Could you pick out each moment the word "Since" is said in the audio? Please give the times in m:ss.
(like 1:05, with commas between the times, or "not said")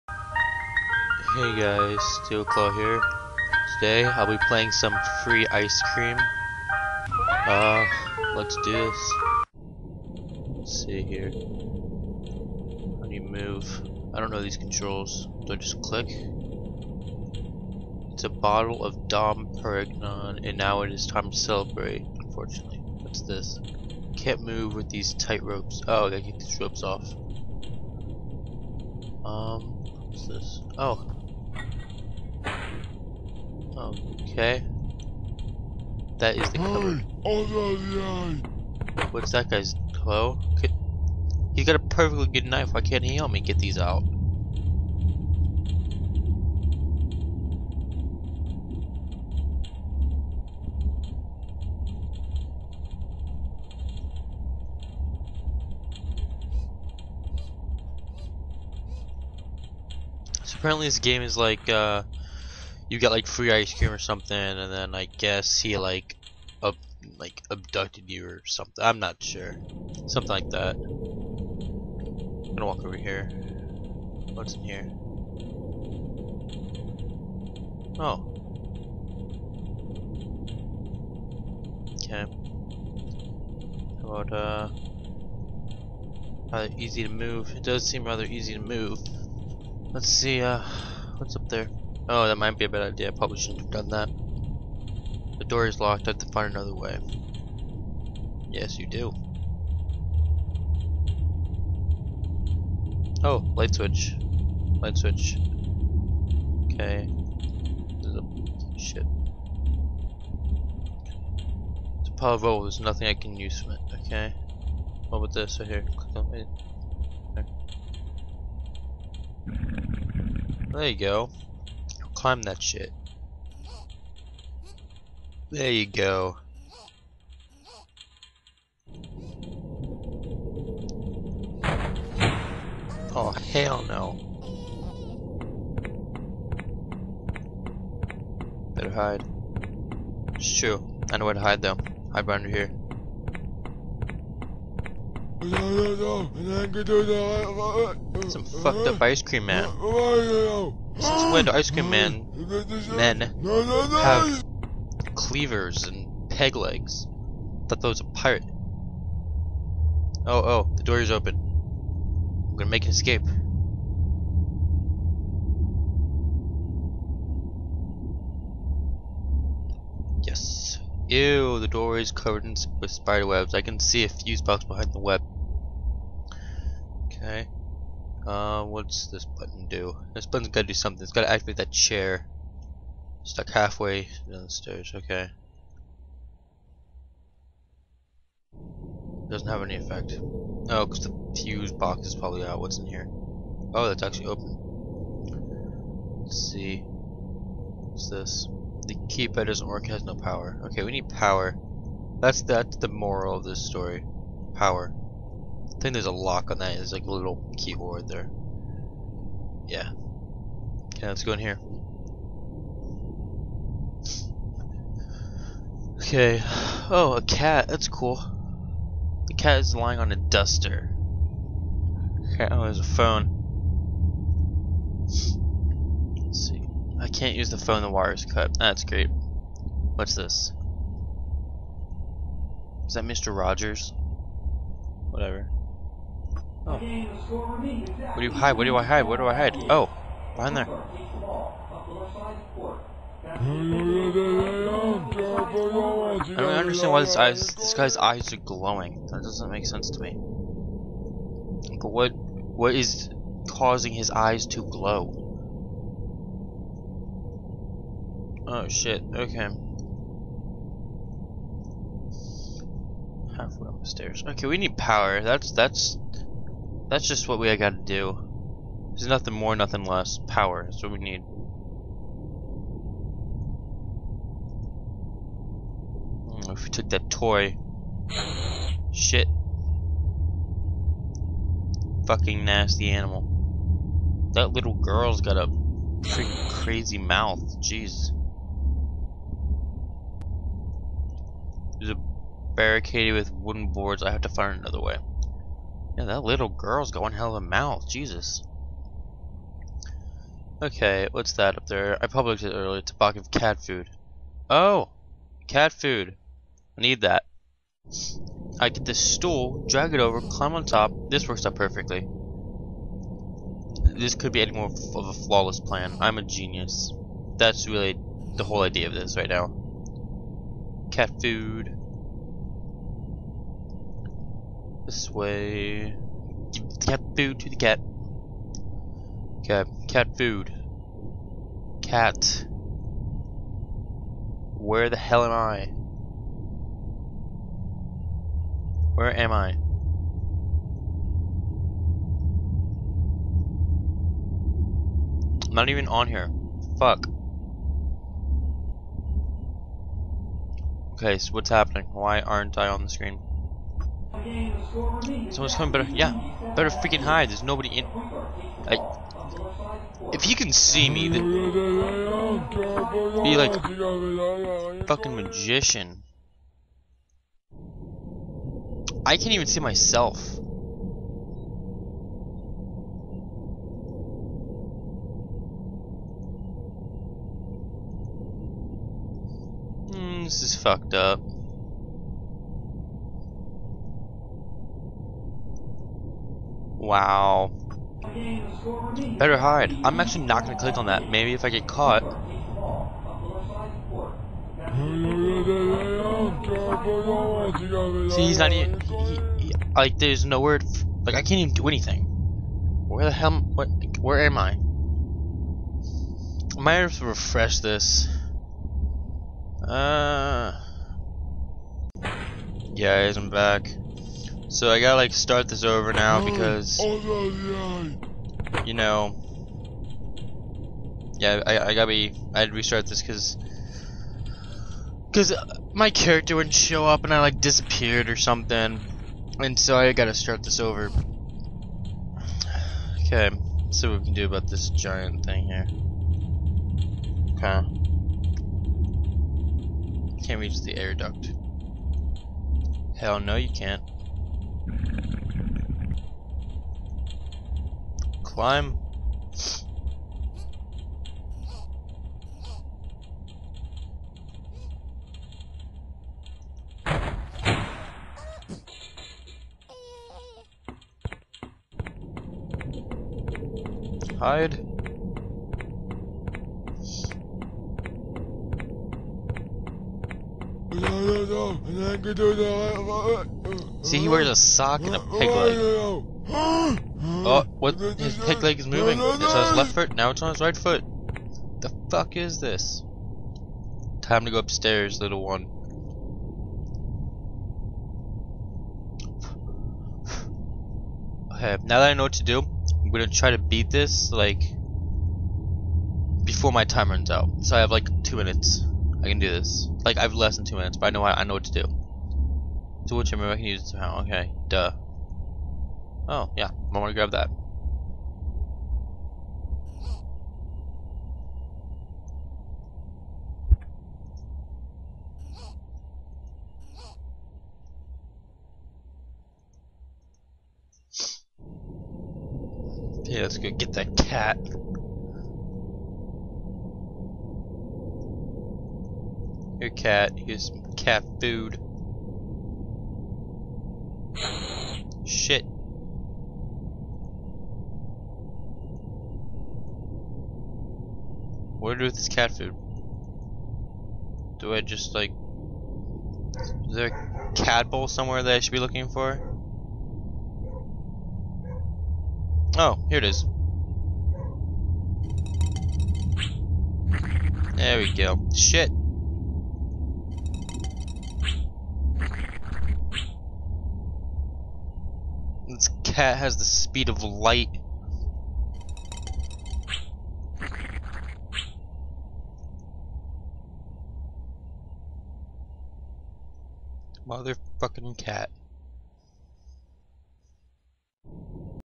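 2:30.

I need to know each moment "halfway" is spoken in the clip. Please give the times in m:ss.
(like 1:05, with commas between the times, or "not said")
3:03, 4:23.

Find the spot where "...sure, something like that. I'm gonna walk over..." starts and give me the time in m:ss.
1:09.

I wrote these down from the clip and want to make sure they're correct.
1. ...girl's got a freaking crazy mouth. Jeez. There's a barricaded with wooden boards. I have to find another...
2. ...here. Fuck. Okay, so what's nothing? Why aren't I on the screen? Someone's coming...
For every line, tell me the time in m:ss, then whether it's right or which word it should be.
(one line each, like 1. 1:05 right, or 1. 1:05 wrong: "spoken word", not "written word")
1. 4:44 right
2. 5:46 wrong: "happening", not "nothing".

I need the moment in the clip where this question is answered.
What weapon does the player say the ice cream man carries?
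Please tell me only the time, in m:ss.
2:35.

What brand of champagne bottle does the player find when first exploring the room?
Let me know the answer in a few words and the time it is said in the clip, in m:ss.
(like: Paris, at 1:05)
Dom Perignon, at 0:19.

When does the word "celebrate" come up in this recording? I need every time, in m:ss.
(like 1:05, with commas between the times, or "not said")
0:21.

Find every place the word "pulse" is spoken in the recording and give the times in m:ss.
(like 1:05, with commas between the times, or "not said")
not said.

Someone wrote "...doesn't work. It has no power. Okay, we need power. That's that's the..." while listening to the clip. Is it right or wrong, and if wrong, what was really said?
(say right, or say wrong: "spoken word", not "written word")
right.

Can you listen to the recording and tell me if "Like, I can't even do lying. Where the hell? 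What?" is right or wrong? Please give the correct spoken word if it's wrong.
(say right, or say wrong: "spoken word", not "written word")
wrong: "anything", not "lying".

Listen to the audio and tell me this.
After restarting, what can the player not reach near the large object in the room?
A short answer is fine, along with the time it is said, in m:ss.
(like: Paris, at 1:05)
The air duct, at 7:20.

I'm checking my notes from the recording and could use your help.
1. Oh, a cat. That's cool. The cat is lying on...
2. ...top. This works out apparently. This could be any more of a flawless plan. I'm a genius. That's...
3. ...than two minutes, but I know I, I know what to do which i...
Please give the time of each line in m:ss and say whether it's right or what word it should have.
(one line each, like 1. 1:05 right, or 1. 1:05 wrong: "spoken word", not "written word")
1. 3:36 right
2. 5:10 wrong: "perfectly", not "apparently"
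3. 8:20 right.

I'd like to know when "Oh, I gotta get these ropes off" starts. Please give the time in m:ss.
0:25.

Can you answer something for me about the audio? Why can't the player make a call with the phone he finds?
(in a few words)
The wire's cut.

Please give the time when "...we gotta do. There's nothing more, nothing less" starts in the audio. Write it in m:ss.
4:27.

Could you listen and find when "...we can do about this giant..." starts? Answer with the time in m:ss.
7:13.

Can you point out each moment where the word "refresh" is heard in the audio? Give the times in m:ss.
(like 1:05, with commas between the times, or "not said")
6:47.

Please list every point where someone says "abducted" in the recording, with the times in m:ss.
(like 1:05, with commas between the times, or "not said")
1:07.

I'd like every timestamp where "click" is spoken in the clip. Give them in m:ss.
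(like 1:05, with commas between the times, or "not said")
0:15, 1:55, 6:30.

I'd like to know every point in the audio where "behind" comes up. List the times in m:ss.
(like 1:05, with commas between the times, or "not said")
2:22, 2:54, 4:00.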